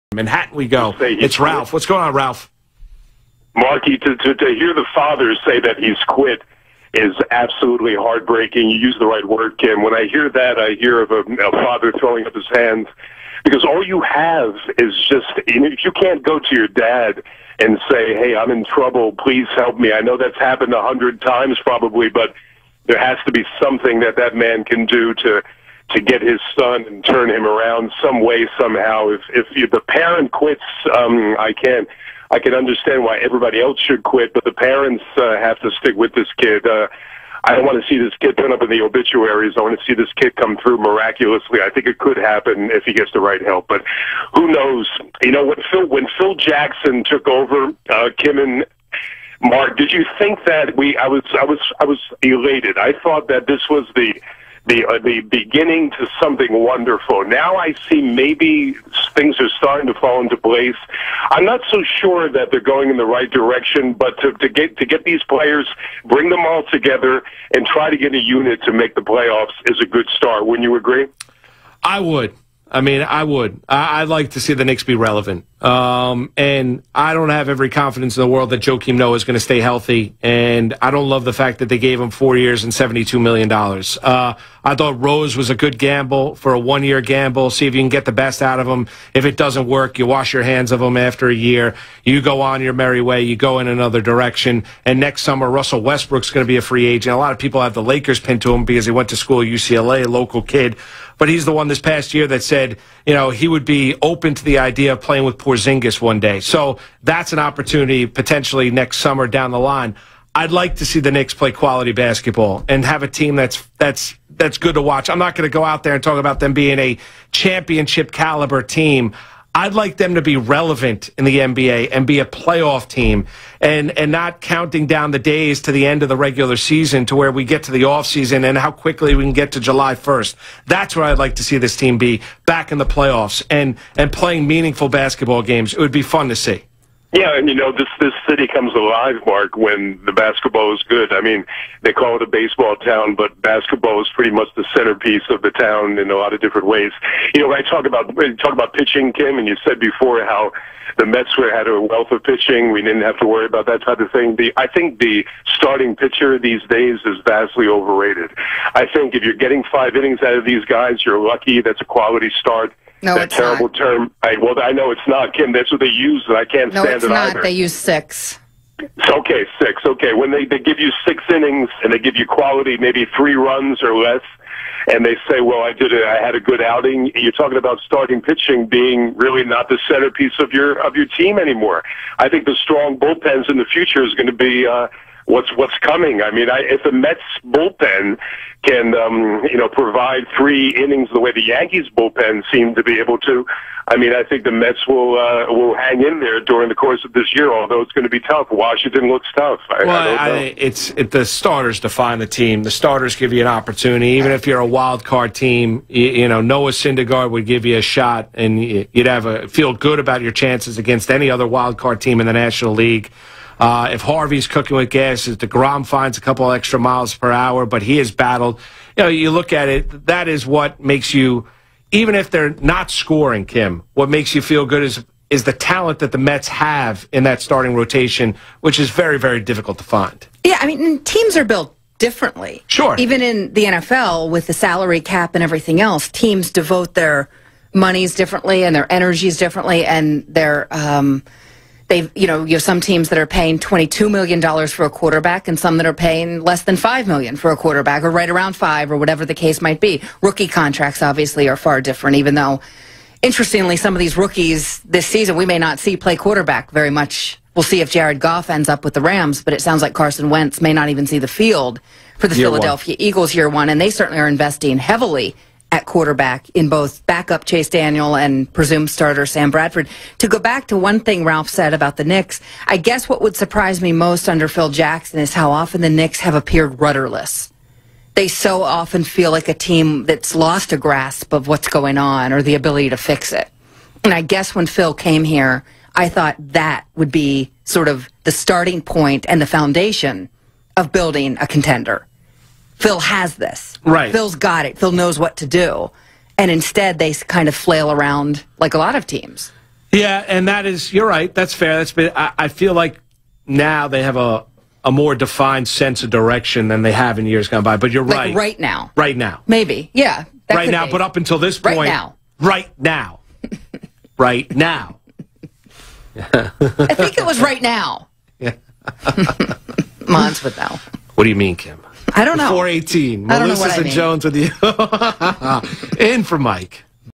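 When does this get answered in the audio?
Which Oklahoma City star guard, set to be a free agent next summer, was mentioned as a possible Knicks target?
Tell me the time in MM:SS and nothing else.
01:35.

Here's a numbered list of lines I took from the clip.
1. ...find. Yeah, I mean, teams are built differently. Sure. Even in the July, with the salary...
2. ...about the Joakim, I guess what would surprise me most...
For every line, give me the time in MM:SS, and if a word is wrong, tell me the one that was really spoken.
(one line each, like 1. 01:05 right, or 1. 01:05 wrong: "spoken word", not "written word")
1. 03:49 wrong: "NFL", not "July"
2. 04:31 wrong: "Knicks", not "Joakim".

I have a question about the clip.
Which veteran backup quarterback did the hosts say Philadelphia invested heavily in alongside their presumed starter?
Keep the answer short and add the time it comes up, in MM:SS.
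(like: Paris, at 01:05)
Chase Daniel, at 04:27.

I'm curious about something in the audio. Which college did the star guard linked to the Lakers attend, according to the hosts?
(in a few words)
UCLA.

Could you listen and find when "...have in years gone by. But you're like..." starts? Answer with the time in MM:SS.
05:06.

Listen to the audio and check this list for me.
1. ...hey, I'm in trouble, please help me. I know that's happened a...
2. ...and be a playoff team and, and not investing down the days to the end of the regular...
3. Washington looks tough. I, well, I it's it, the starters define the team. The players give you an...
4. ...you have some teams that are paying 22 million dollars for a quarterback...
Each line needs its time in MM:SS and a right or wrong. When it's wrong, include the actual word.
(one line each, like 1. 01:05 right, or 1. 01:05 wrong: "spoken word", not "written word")
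1. 00:18 right
2. 02:01 wrong: "counting", not "investing"
3. 03:18 wrong: "starters", not "players"
4. 04:02 right.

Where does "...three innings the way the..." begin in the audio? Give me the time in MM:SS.
03:10.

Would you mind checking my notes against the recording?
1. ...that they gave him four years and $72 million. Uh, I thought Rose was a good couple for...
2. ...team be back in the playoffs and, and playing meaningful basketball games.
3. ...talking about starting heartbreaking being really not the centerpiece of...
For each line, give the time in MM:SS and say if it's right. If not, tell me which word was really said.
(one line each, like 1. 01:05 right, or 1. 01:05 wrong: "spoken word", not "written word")
1. 01:21 wrong: "gamble", not "couple"
2. 02:11 right
3. 02:57 wrong: "pitching", not "heartbreaking".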